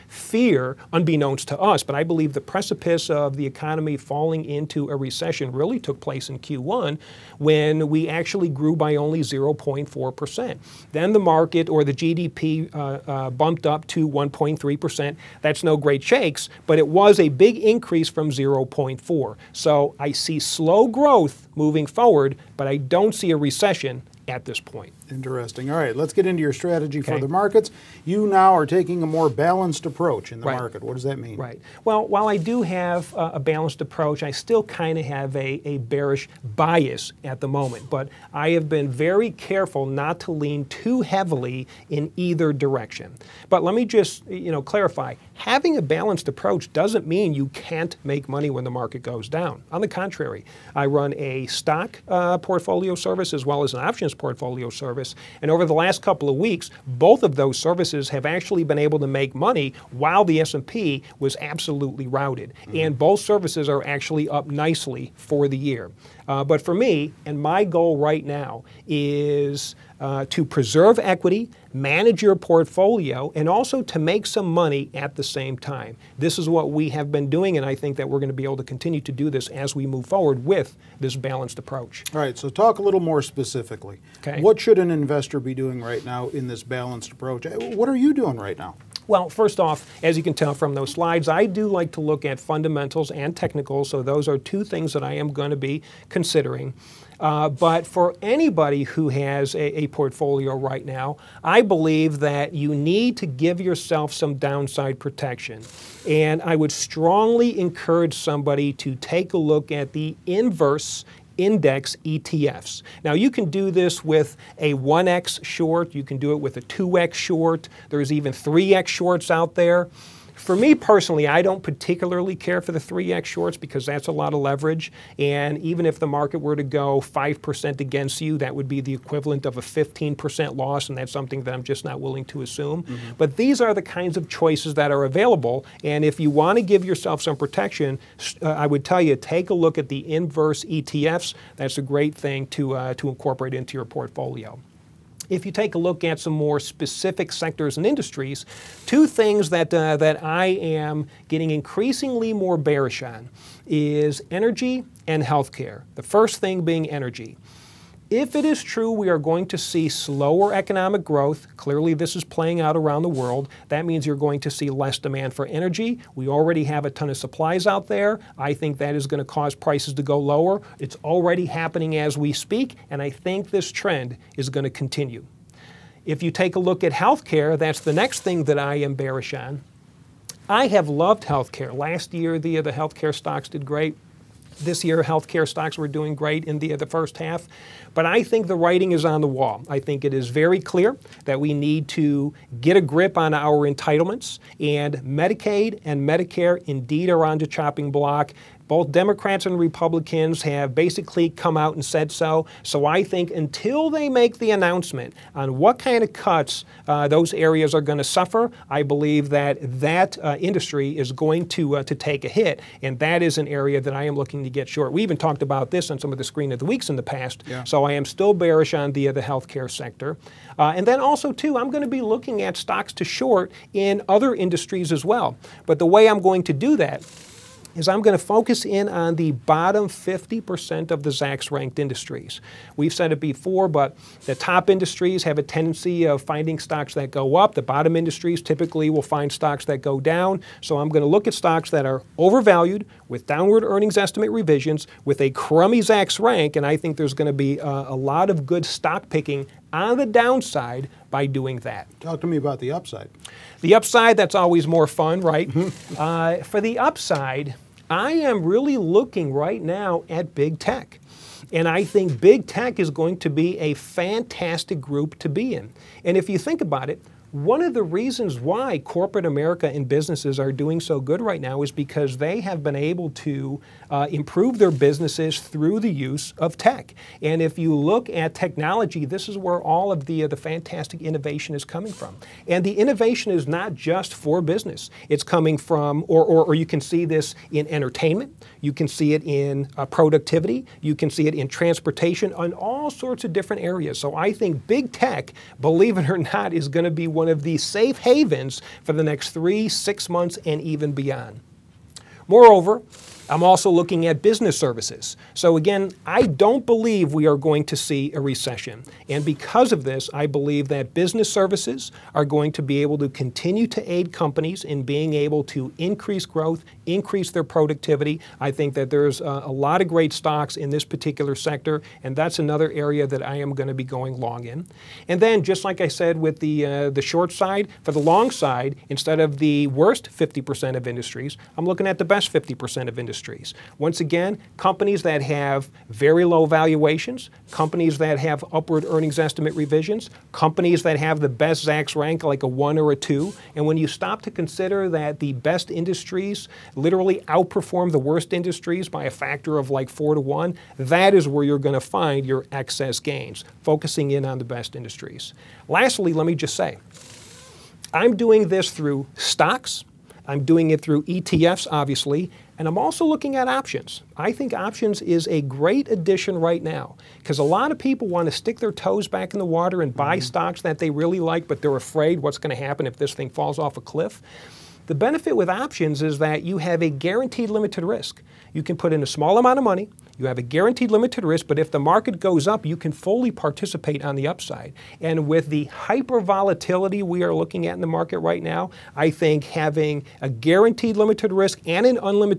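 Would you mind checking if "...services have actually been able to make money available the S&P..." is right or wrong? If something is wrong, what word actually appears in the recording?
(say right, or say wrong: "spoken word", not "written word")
wrong: "while", not "available".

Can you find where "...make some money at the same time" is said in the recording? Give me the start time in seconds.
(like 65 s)
73 s.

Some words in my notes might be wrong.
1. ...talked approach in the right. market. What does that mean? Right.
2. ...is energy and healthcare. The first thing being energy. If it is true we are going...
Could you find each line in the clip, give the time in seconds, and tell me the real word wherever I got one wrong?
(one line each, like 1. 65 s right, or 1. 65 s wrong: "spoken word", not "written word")
1. 29 s wrong: "balanced", not "talked"
2. 153 s right.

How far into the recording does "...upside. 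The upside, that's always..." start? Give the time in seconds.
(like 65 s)
252 s.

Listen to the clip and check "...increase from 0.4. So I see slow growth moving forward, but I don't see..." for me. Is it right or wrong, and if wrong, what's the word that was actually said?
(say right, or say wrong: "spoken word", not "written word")
right.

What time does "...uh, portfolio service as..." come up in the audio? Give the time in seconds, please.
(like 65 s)
52 s.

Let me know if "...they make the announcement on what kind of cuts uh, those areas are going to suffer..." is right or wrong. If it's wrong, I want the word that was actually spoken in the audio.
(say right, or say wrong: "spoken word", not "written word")
right.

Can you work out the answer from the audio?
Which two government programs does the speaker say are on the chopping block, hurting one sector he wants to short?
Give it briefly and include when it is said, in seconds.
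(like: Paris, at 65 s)
Medicaid and Medicare, at 194 s.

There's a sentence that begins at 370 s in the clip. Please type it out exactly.
stocks that they really like, but they're afraid what's going to happen if this thing falls off a cliff.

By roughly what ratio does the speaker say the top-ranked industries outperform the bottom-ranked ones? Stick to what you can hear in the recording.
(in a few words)
4 to 1.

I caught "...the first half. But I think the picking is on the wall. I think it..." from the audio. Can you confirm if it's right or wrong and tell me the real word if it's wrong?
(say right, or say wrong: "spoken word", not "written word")
wrong: "writing", not "picking".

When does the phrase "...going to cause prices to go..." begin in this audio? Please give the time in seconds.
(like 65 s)
169 s.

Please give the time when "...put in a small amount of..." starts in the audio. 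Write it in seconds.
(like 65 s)
378 s.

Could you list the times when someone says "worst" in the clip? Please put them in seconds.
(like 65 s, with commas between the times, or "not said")
329 s, 347 s.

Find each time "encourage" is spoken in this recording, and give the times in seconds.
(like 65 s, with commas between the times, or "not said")
107 s.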